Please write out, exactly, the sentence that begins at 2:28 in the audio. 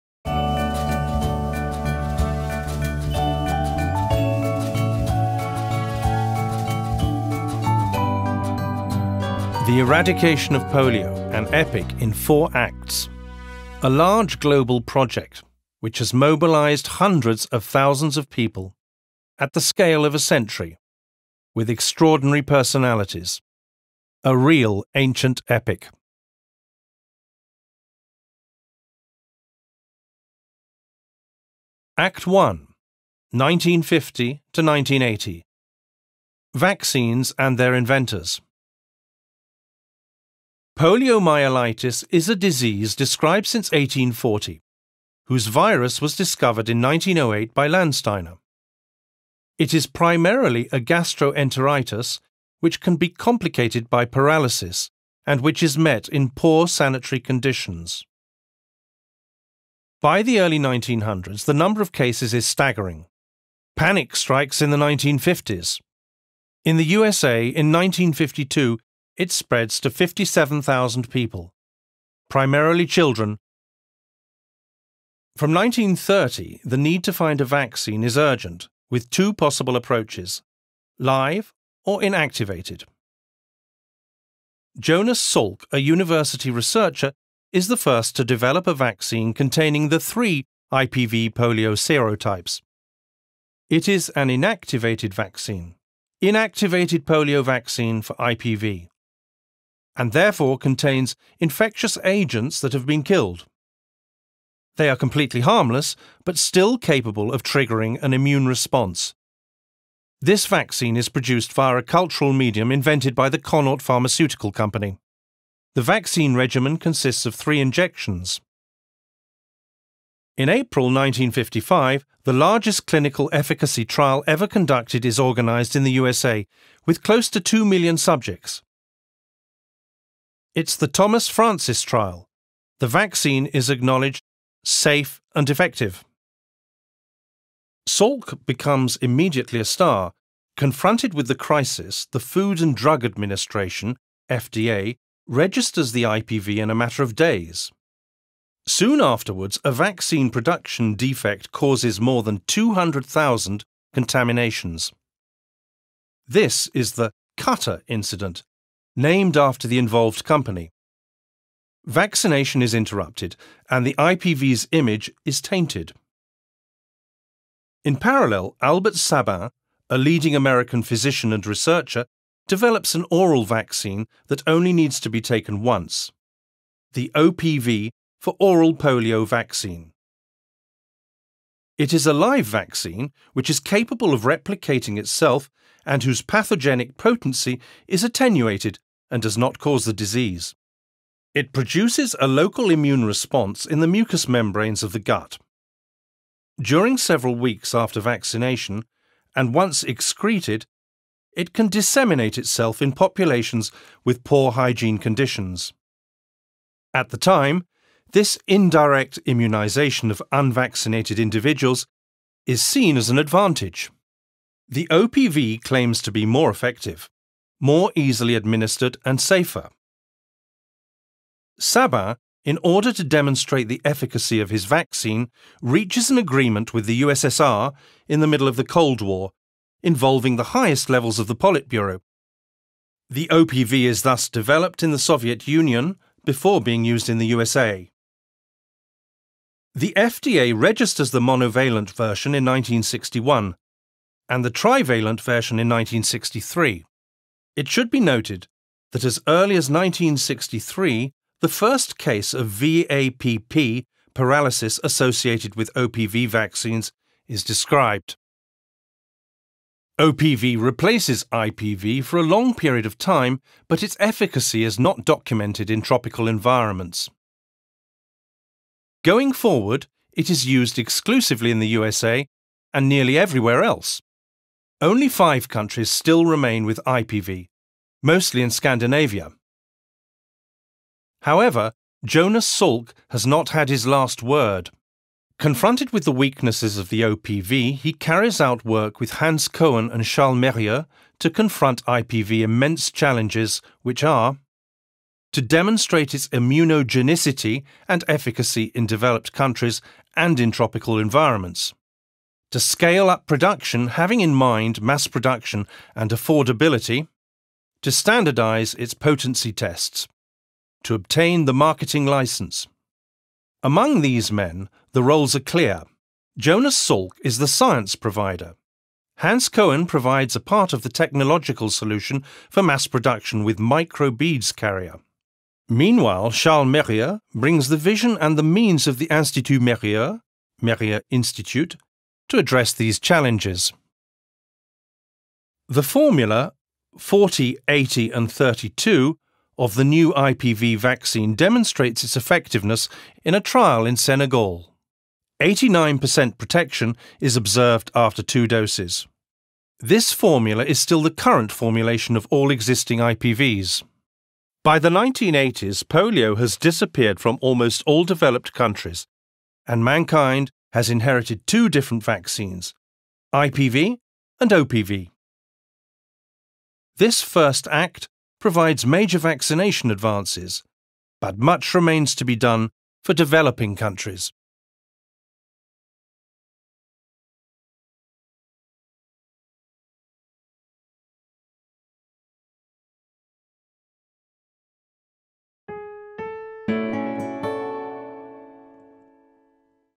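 Soon afterwards, a vaccine production defect causes more than 200,000 contaminations.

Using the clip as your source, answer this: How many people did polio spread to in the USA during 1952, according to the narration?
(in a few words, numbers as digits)
57,000.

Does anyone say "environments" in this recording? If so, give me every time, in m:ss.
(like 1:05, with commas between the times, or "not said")
4:26, 5:00.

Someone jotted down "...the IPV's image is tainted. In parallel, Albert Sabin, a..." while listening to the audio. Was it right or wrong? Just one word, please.
right.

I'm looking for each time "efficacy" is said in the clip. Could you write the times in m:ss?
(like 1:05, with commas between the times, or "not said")
2:03, 3:43, 4:23, 4:58.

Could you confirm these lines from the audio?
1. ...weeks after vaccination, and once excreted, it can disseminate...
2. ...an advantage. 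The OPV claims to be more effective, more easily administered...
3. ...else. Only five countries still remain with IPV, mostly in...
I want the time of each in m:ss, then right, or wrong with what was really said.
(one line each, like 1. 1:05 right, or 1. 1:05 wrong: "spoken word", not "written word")
1. 3:17 right
2. 3:33 right
3. 4:33 right.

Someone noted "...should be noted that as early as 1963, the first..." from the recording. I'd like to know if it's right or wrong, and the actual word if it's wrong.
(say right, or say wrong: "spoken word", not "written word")
right.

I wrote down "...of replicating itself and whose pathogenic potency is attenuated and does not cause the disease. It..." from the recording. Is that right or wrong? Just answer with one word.
right.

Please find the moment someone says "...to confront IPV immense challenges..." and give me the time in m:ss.
4:51.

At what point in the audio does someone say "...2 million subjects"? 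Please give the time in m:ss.
2:07.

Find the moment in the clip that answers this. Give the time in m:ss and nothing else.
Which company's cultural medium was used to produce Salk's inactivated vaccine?
1:53.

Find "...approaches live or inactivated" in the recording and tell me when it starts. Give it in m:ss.
1:19.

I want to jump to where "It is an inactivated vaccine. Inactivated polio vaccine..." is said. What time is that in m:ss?
1:33.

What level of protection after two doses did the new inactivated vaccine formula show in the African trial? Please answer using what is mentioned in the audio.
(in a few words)
89%.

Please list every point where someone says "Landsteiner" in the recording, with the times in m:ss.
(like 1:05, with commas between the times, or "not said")
0:47.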